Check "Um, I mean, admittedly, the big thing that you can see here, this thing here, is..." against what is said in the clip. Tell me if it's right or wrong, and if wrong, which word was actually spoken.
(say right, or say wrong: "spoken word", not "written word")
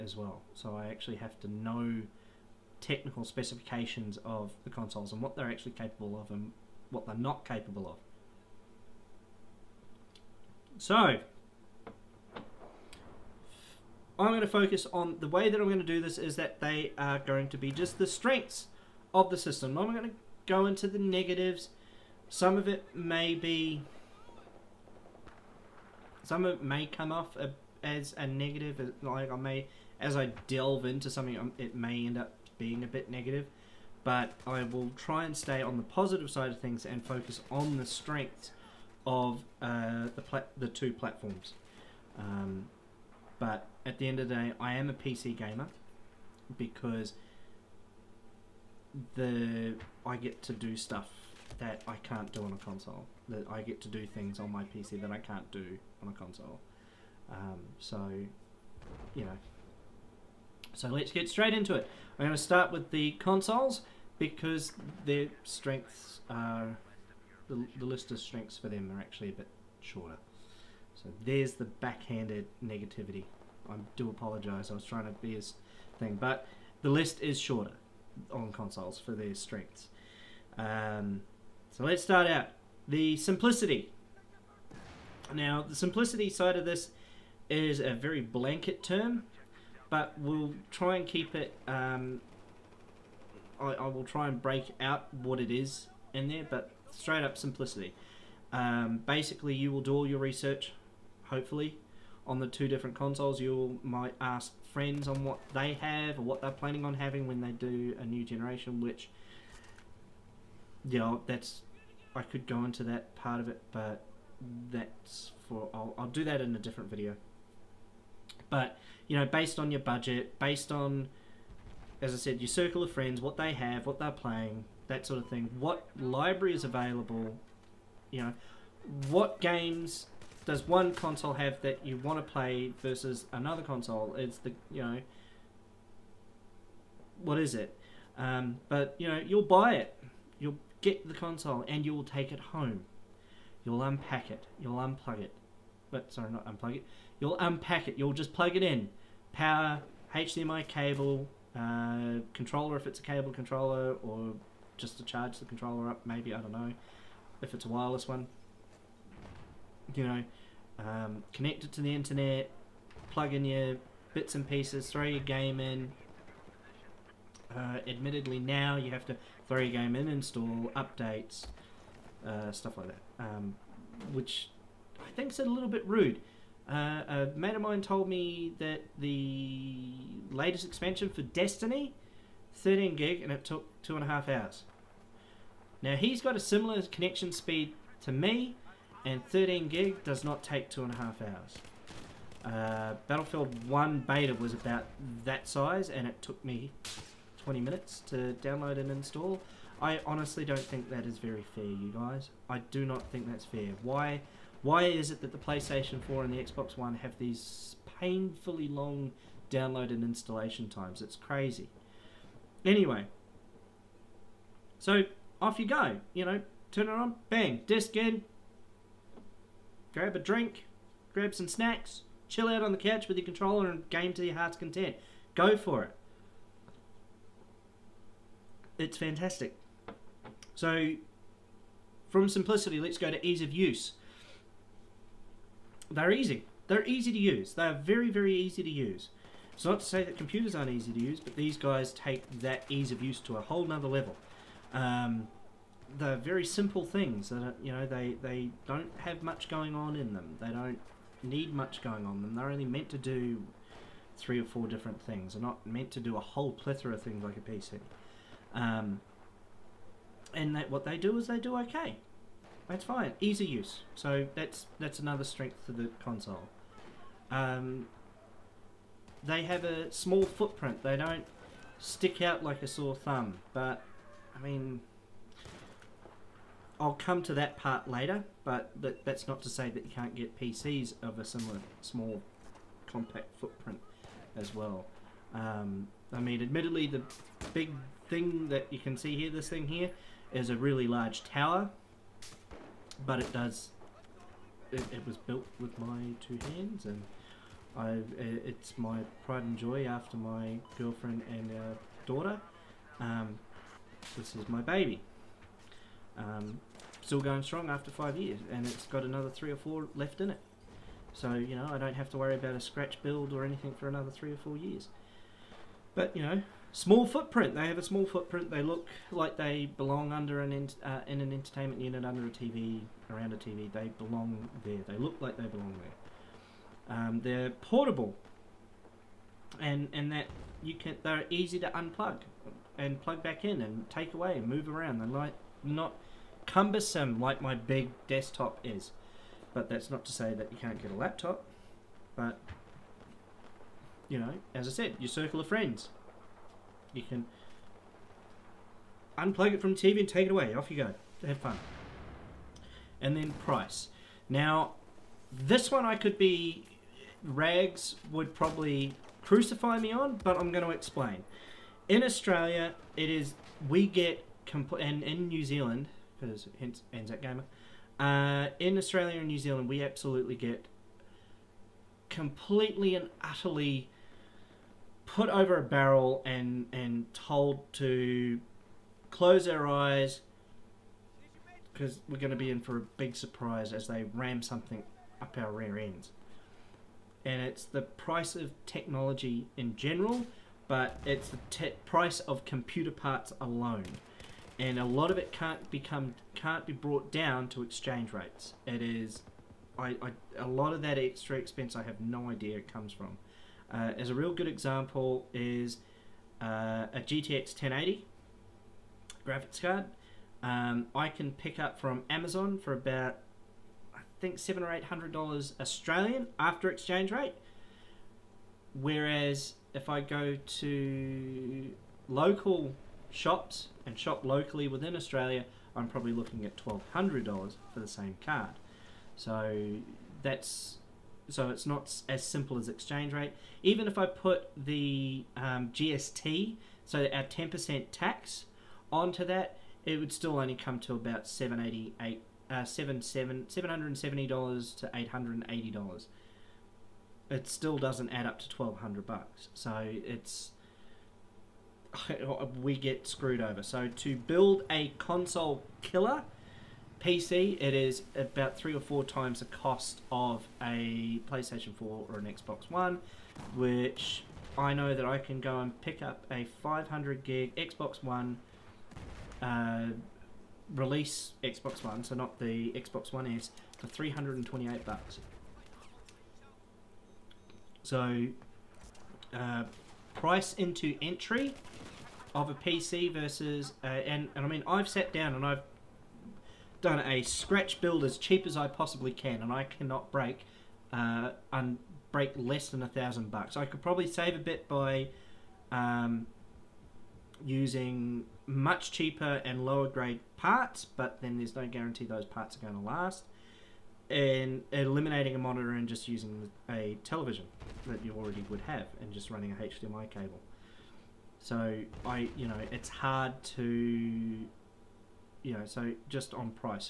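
right.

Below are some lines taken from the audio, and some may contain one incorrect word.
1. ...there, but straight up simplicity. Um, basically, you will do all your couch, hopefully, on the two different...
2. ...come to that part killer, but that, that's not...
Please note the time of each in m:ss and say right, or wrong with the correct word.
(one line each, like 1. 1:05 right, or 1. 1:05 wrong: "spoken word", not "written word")
1. 1:36 wrong: "research", not "couch"
2. 4:36 wrong: "later", not "killer".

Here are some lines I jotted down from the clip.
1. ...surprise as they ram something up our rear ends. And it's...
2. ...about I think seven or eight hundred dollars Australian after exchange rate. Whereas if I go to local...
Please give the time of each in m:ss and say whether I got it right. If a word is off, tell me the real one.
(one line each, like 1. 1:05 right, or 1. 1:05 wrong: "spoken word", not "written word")
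1. 6:23 right
2. 6:52 right.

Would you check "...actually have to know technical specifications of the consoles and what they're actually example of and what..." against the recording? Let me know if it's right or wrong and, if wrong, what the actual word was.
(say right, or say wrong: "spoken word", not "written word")
wrong: "capable", not "example".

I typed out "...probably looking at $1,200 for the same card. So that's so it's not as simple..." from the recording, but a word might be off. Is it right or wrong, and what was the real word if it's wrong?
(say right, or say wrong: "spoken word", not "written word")
right.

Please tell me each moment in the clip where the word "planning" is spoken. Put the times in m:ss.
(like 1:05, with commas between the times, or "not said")
1:46.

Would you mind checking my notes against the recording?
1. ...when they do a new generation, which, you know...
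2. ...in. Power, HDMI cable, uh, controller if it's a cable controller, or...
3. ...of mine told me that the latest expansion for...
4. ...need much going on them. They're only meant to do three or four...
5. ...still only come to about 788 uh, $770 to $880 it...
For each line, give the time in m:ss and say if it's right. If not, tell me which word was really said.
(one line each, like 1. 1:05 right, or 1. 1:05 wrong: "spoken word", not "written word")
1. 1:47 right
2. 2:28 right
3. 2:57 right
4. 4:11 right
5. 7:20 right.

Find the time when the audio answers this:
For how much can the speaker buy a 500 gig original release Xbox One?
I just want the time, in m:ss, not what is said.
7:53.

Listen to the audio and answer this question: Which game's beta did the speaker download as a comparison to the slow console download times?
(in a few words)
Battlefield 1.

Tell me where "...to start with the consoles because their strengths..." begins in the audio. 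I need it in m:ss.
1:02.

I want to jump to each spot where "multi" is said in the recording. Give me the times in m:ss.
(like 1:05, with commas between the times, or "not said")
not said.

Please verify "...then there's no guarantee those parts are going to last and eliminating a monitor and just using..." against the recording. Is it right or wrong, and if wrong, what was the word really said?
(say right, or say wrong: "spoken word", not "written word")
right.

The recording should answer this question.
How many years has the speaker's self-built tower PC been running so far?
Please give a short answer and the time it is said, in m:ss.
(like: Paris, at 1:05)
five years, at 5:07.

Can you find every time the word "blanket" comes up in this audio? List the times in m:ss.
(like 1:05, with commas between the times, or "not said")
1:28.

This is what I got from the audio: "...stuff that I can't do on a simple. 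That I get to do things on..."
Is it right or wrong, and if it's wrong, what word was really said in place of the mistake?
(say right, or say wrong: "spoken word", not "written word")
wrong: "console", not "simple".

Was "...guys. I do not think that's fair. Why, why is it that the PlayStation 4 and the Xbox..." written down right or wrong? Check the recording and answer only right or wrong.
right.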